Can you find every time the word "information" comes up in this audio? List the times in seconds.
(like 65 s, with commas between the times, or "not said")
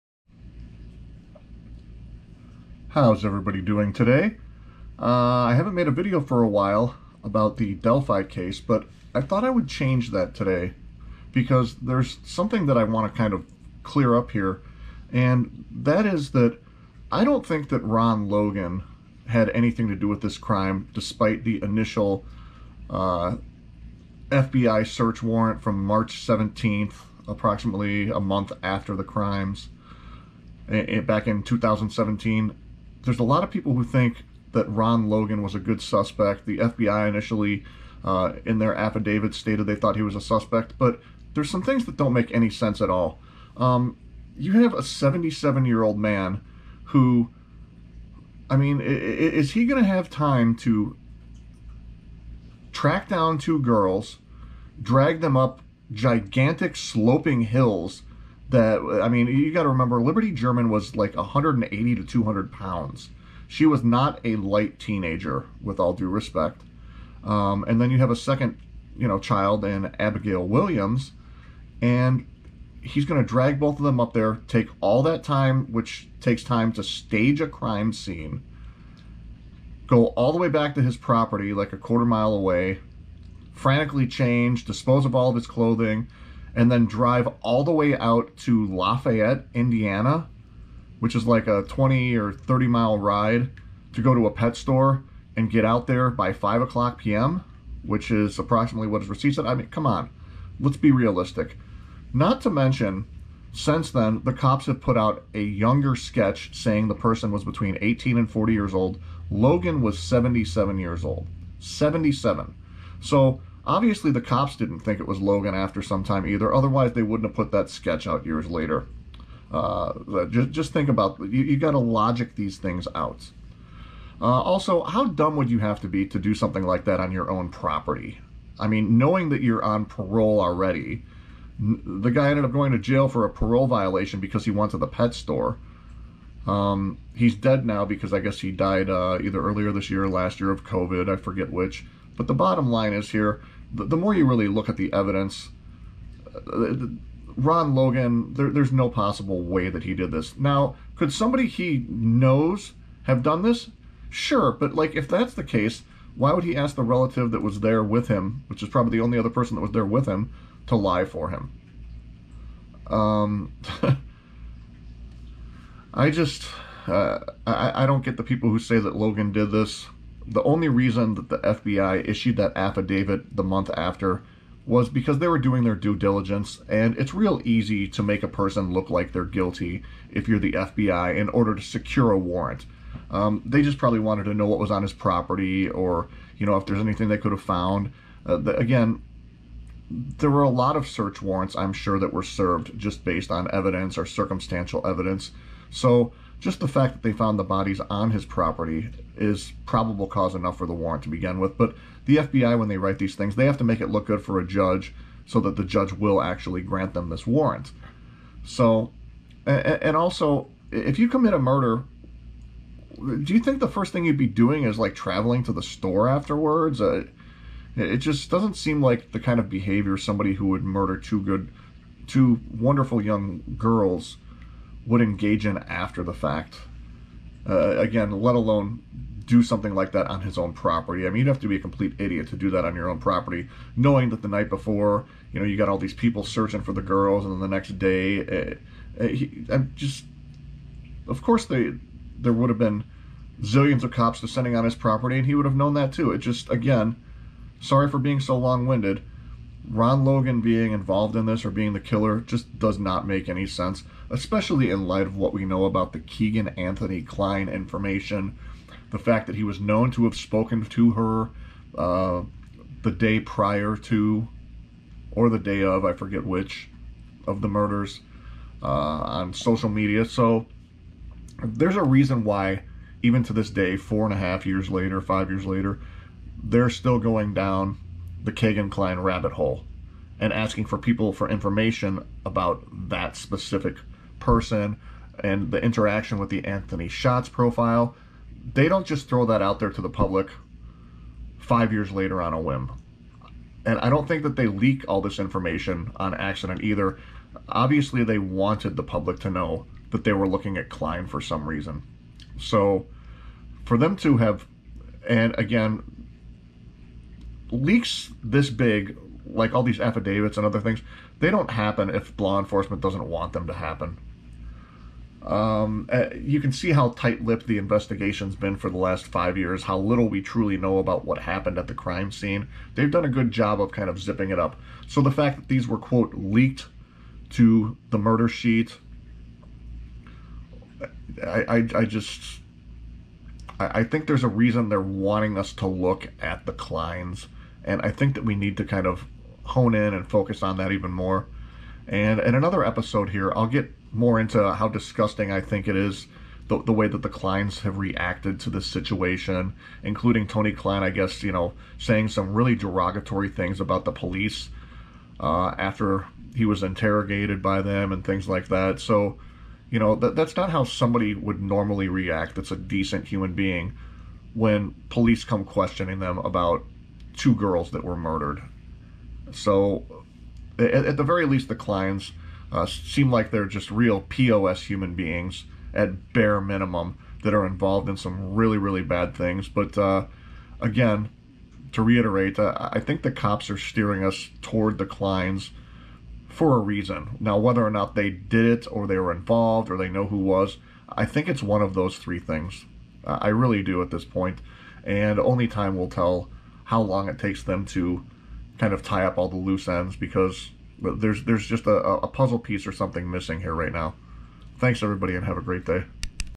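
257 s, 281 s, 295 s.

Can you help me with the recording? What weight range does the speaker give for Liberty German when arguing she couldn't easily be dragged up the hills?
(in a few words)
180 to 200 pounds.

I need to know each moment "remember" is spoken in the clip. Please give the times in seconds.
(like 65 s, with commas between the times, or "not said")
59 s.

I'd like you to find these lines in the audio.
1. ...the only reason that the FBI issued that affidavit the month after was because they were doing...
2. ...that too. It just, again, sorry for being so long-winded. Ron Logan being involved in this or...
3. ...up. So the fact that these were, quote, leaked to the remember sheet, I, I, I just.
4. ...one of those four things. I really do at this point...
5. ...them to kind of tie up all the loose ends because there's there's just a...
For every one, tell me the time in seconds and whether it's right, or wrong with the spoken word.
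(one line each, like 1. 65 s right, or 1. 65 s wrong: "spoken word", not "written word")
1. 170 s right
2. 245 s right
3. 324 s wrong: "murder", not "remember"
4. 391 s wrong: "three", not "four"
5. 397 s right.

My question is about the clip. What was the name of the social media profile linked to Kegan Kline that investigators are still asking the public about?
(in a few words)
Anthony Shots.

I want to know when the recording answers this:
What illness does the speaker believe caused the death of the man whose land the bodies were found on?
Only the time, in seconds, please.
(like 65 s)
140 s.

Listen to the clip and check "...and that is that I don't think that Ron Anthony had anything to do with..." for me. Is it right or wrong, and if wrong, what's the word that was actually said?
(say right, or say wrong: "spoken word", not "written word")
wrong: "Logan", not "Anthony".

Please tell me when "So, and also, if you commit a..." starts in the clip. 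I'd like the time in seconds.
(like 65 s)
208 s.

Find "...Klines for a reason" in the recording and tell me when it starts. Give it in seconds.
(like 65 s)
384 s.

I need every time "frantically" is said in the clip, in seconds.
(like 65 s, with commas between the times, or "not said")
83 s.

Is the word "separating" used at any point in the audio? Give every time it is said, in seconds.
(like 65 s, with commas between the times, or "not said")
not said.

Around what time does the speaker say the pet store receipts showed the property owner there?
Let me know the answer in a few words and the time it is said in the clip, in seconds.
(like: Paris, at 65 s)
5 o'clock p.m., at 96 s.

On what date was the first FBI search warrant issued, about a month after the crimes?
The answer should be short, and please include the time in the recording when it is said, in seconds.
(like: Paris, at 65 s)
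March 17th, at 25 s.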